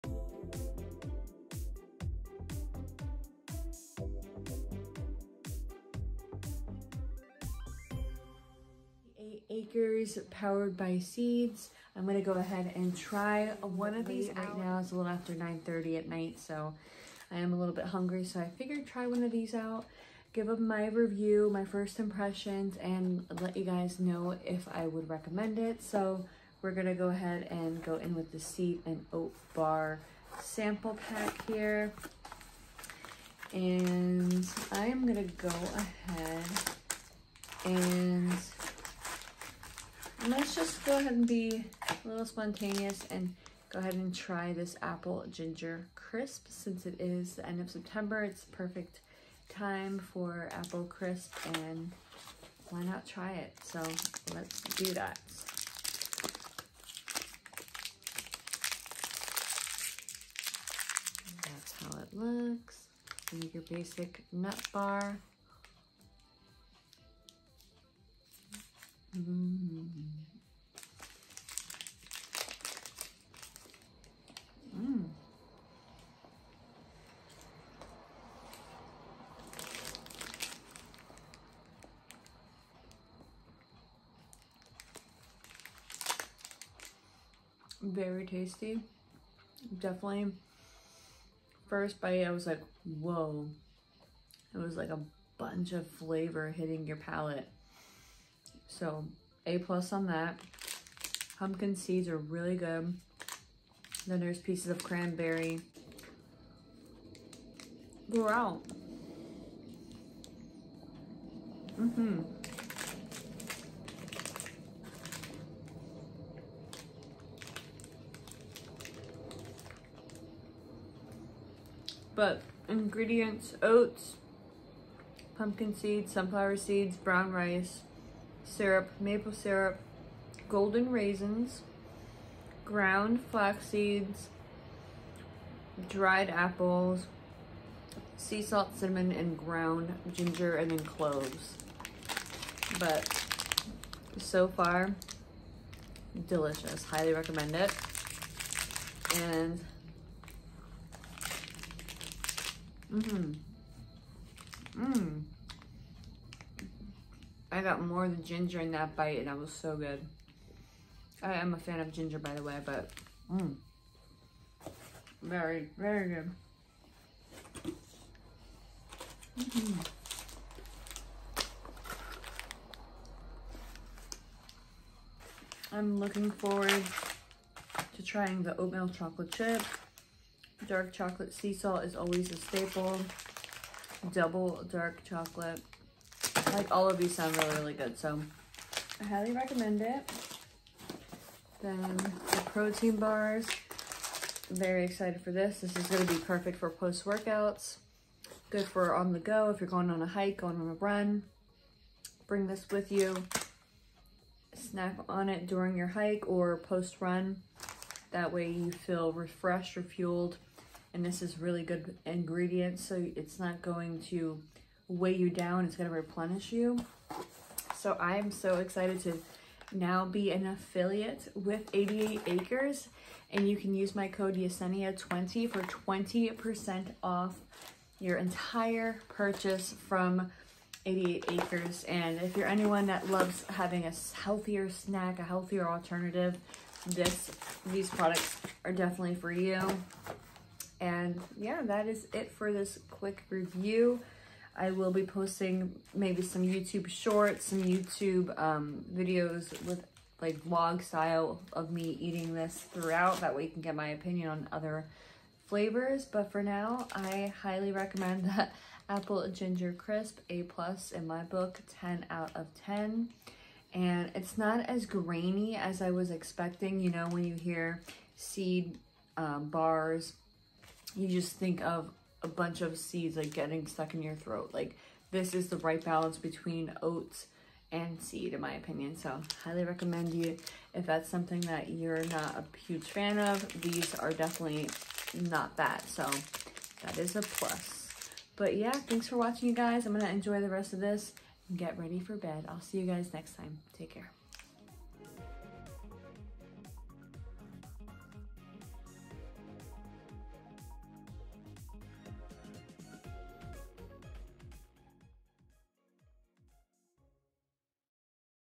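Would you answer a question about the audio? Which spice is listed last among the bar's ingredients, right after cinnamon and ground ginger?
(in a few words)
Cloves.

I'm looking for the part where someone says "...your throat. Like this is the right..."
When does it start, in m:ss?
4:34.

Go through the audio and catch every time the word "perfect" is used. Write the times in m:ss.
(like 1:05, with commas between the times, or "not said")
0:48, 3:16.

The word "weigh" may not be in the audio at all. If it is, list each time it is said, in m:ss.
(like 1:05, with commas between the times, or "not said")
3:34.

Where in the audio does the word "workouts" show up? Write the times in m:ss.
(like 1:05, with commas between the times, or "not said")
3:16.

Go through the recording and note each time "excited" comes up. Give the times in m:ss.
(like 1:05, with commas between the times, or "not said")
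3:14, 3:38.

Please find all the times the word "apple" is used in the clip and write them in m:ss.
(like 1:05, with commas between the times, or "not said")
0:44, 0:50, 2:16, 4:18.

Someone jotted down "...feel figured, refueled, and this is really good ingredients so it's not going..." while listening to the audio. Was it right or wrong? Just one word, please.
wrong.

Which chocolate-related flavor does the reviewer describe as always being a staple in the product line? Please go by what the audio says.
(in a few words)
Dark chocolate sea salt.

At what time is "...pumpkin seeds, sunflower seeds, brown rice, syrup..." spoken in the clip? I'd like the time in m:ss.
2:05.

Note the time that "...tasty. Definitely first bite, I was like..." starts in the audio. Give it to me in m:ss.
1:28.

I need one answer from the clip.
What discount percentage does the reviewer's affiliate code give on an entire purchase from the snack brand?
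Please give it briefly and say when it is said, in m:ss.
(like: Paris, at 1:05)
20%, at 3:45.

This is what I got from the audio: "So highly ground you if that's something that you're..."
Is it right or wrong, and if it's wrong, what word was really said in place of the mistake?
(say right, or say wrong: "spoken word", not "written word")
wrong: "recommend", not "ground".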